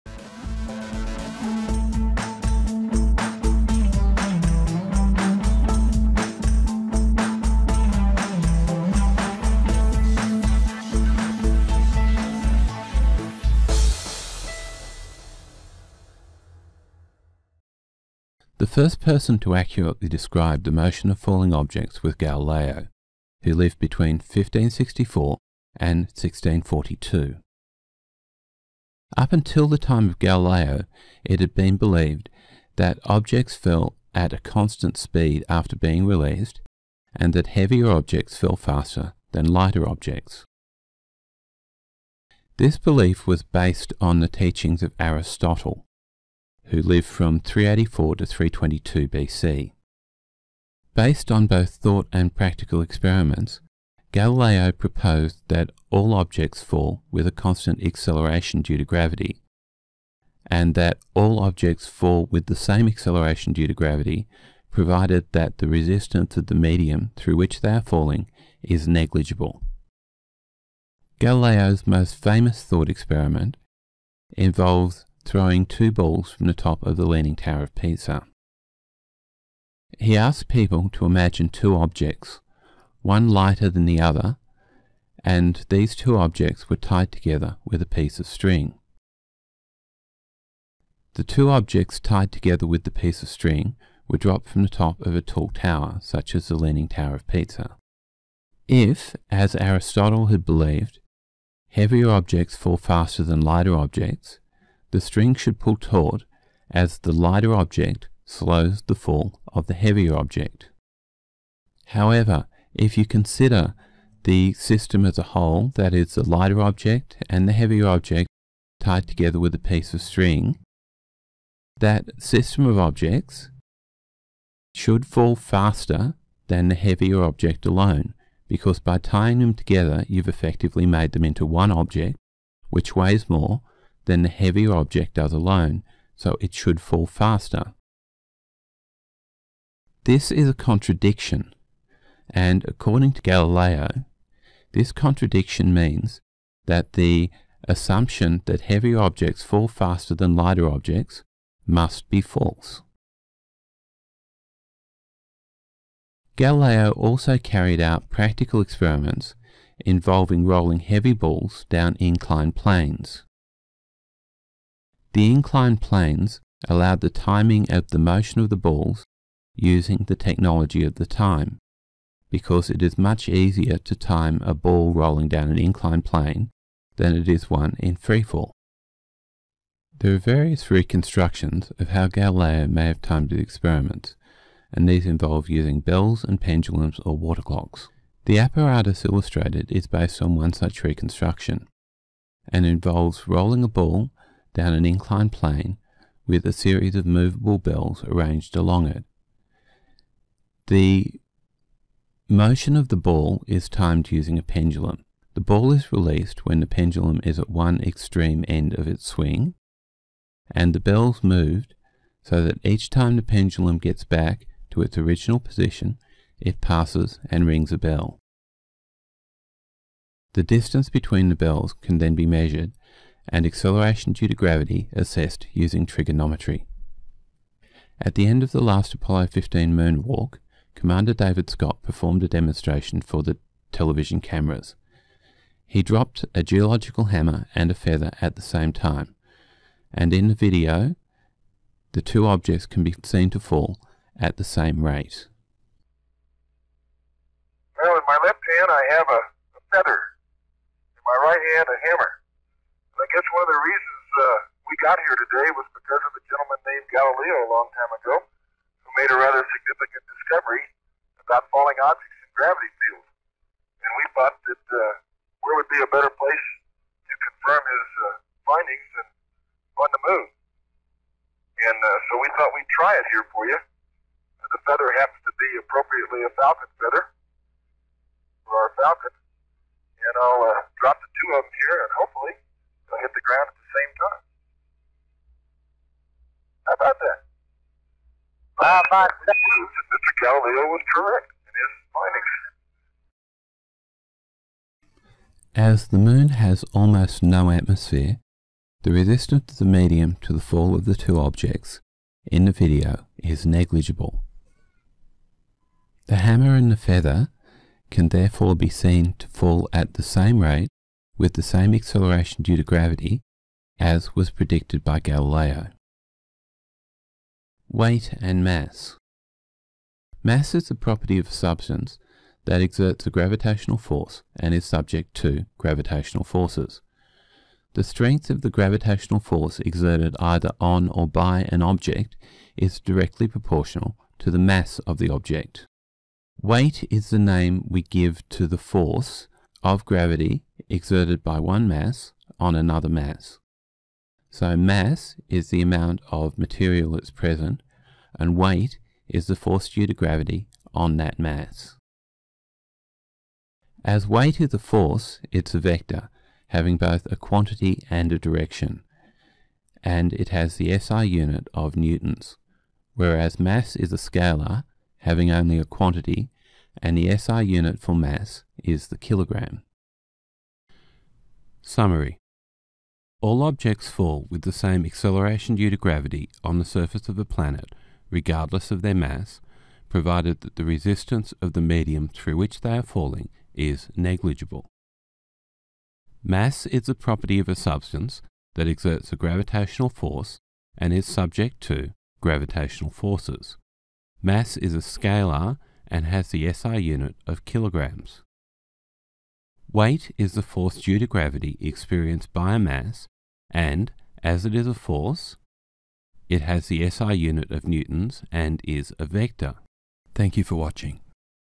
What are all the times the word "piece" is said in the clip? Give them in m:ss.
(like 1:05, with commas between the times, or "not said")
1:27, 1:32, 1:59.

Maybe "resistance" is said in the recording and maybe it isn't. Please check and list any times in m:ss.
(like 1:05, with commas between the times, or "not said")
1:05, 4:58, 6:20.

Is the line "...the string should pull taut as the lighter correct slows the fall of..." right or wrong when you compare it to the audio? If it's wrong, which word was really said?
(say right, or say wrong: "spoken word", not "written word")
wrong: "object", not "correct".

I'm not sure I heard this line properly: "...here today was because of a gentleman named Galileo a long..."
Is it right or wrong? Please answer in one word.
right.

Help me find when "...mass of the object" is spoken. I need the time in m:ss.
5:34.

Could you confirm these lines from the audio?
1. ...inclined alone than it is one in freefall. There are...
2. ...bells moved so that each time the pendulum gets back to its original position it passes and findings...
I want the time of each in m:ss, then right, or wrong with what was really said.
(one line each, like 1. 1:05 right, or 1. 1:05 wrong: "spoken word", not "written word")
1. 2:55 wrong: "plane", not "alone"
2. 3:30 wrong: "rings", not "findings".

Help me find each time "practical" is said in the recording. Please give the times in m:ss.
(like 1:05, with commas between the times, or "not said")
0:52, 2:38.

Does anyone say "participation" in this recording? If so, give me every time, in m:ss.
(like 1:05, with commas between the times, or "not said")
not said.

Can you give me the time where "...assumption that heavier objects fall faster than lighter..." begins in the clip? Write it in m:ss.
2:27.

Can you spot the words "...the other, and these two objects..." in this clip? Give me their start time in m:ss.
1:23.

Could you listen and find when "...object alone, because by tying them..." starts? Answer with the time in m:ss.
2:07.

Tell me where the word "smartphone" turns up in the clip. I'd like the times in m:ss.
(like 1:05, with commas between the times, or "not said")
not said.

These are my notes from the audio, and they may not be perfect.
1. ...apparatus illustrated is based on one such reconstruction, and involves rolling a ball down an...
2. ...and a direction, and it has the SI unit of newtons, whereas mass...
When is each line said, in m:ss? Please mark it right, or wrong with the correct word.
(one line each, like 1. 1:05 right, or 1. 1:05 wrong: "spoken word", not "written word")
1. 3:08 right
2. 5:57 right.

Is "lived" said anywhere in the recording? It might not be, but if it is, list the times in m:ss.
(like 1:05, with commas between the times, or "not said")
0:23, 0:46.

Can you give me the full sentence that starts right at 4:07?
Now in my left hand I have a, a feather, in my right hand a hammer.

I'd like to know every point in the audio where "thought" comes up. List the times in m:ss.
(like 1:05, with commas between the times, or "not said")
0:51, 1:12, 4:24, 4:32.